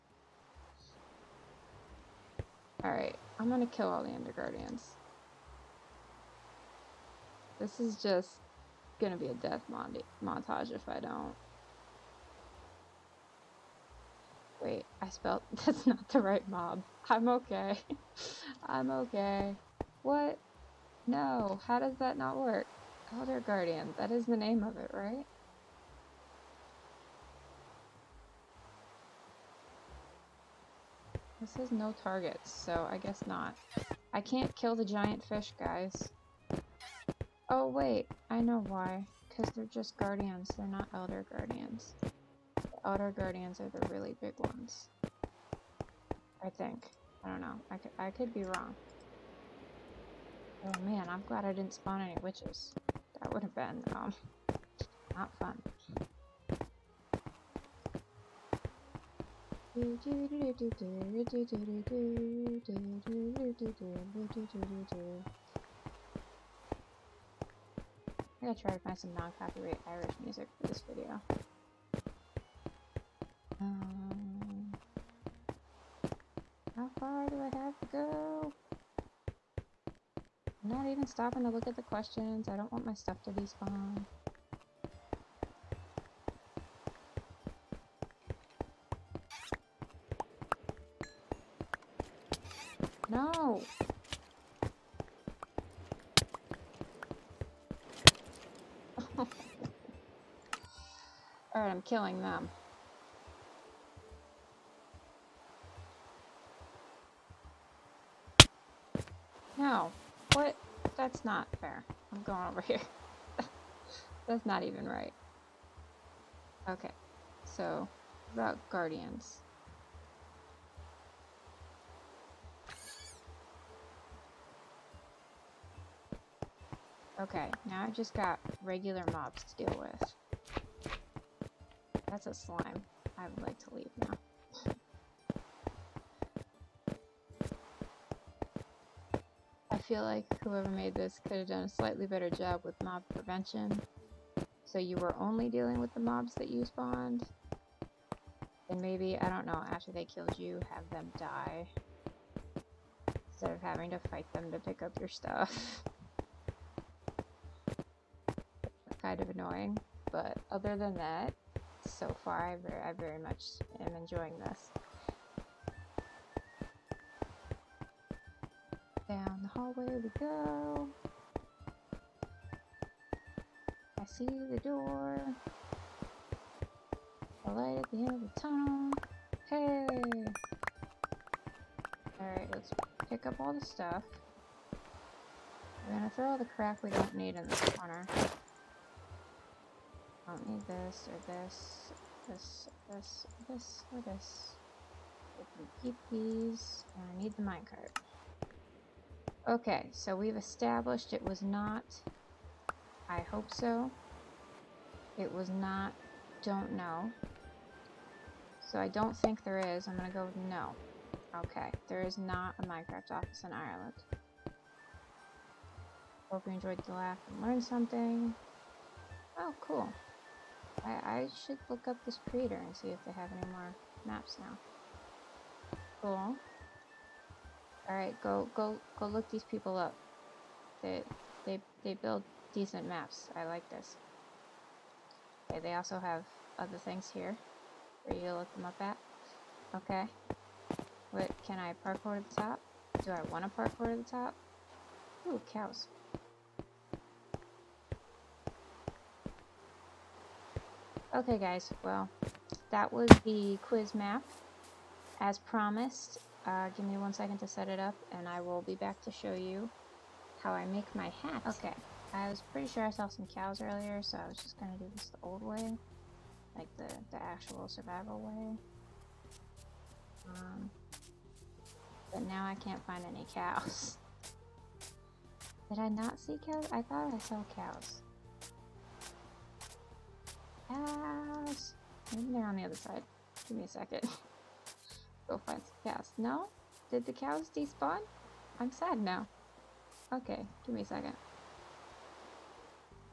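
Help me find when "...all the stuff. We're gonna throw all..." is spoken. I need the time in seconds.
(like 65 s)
183 s.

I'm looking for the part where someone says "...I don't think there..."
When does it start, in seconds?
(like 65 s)
208 s.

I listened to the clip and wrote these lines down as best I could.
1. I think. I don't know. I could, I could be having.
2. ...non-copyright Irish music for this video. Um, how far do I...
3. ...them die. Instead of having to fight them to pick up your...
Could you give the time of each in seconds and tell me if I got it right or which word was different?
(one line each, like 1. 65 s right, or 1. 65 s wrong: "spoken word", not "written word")
1. 46 s wrong: "wrong", not "having"
2. 69 s right
3. 150 s right.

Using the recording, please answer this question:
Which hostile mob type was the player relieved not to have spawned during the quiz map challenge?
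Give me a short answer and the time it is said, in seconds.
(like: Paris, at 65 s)
witches, at 52 s.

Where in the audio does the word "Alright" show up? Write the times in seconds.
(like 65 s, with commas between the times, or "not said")
2 s, 182 s, 227 s.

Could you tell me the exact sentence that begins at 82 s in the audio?
I don't want my stuff to be spawned.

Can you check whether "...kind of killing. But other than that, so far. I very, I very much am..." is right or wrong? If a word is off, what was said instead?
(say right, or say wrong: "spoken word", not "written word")
wrong: "annoying", not "killing".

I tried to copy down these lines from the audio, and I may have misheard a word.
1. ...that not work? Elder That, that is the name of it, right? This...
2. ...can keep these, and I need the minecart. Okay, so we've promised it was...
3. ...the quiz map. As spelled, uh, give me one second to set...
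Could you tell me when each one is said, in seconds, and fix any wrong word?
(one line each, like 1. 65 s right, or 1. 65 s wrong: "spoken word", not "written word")
1. 21 s wrong: "Guardian", not "That"
2. 195 s wrong: "established", not "promised"
3. 253 s wrong: "promised", not "spelled".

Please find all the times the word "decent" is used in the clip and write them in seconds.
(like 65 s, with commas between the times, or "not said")
232 s.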